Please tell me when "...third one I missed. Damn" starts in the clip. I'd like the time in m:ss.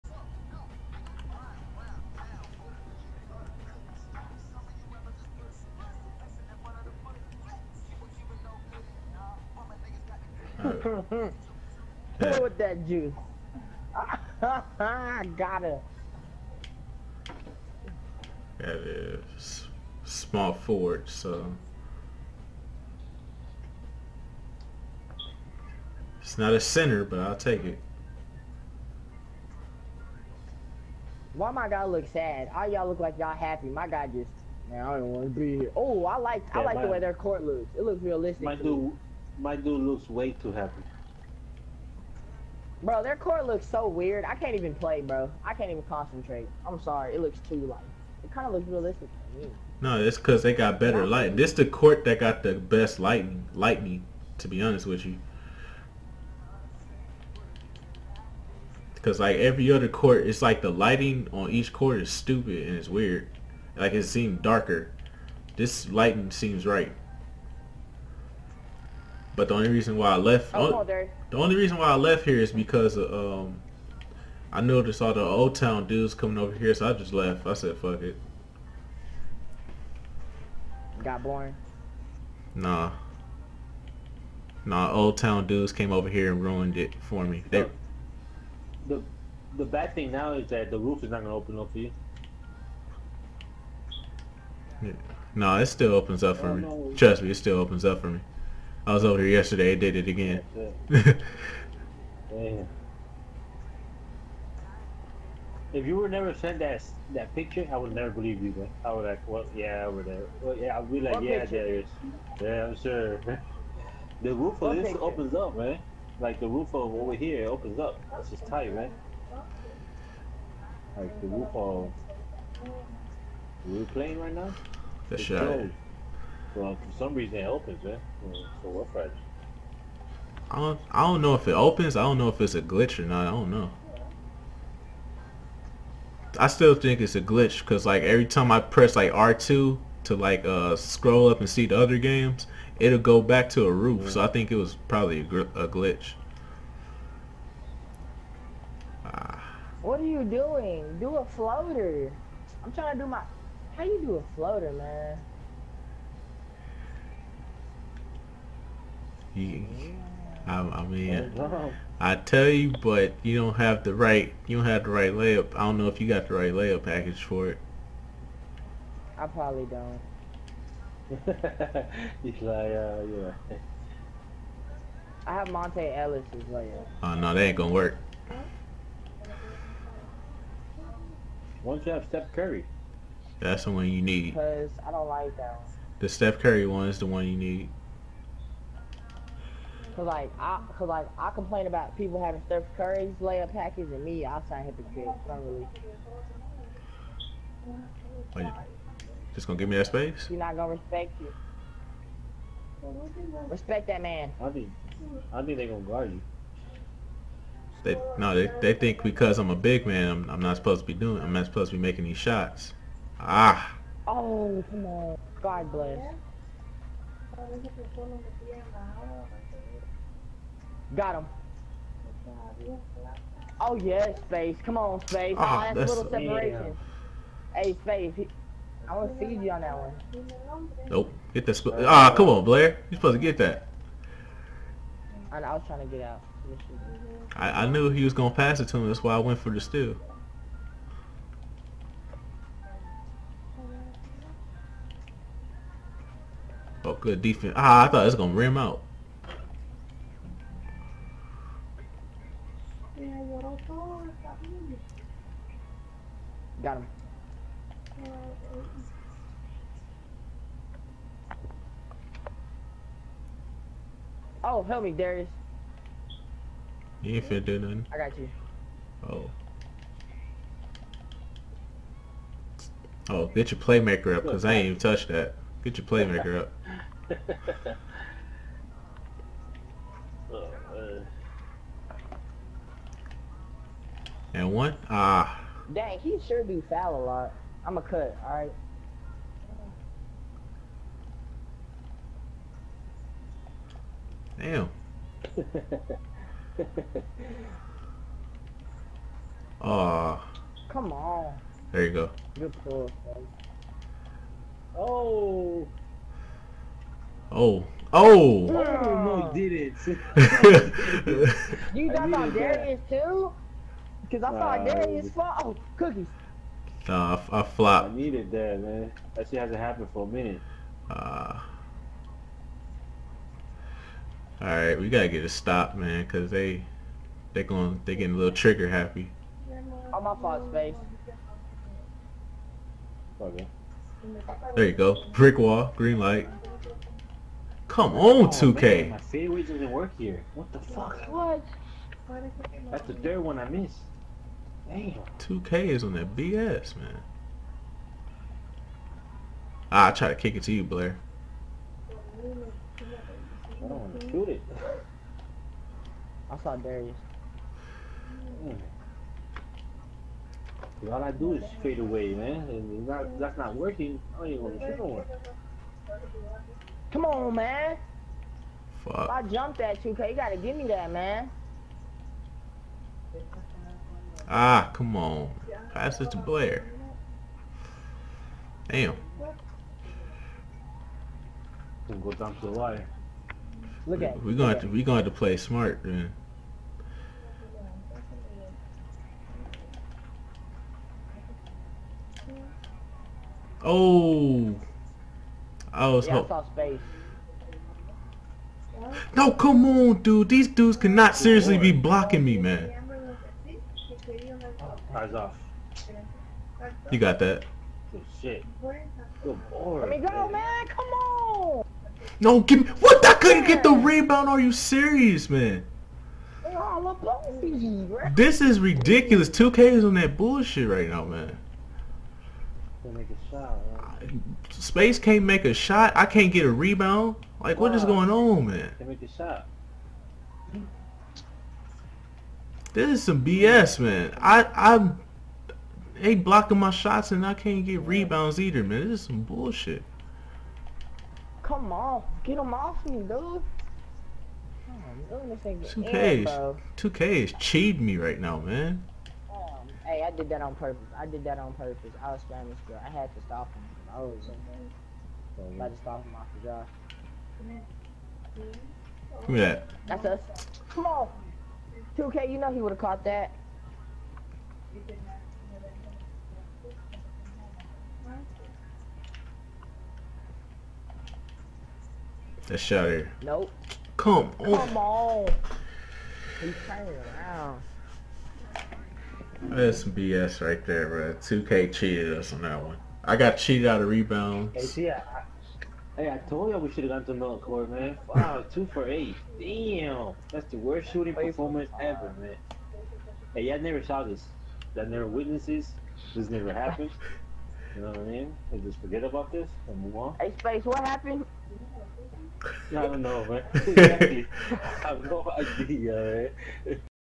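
5:42.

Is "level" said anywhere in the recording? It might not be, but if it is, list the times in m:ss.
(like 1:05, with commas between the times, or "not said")
not said.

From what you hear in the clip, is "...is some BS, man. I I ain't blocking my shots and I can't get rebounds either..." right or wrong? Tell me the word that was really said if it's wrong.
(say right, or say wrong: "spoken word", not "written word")
right.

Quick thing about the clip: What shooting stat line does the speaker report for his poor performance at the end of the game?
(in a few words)
2 for 8.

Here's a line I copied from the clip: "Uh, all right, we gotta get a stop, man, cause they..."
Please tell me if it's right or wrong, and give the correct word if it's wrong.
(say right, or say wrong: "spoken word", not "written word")
right.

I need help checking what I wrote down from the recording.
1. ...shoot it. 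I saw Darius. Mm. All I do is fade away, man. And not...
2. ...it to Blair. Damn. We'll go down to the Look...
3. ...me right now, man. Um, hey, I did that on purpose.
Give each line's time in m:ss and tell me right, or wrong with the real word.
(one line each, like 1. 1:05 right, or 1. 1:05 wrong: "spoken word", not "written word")
1. 5:54 right
2. 6:15 right
3. 7:27 right.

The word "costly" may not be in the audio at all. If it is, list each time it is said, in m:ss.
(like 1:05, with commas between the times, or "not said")
not said.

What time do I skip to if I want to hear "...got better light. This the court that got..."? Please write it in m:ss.
0:50.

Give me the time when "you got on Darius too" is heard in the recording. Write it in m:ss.
5:11.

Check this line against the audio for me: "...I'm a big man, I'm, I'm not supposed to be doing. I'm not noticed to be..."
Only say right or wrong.
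wrong.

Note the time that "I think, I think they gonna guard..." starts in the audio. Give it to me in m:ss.
3:24.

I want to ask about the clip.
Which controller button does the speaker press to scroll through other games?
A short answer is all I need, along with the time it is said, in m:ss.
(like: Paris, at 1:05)
R2, at 2:19.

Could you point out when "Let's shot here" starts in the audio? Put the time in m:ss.
7:52.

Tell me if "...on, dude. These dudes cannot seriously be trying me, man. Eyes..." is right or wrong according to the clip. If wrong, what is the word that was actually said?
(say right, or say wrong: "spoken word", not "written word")
wrong: "blocking", not "trying".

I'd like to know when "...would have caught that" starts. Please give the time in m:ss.
7:42.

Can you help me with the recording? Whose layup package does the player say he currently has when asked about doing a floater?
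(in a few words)
Monta Ellis.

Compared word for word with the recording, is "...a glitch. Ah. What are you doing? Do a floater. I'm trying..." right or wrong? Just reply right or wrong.
right.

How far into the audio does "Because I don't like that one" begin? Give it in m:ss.
3:04.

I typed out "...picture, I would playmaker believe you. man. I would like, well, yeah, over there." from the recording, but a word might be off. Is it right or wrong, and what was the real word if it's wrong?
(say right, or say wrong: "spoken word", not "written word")
wrong: "never", not "playmaker".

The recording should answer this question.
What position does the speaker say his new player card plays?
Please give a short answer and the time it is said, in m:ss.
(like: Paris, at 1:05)
Small forward, at 0:20.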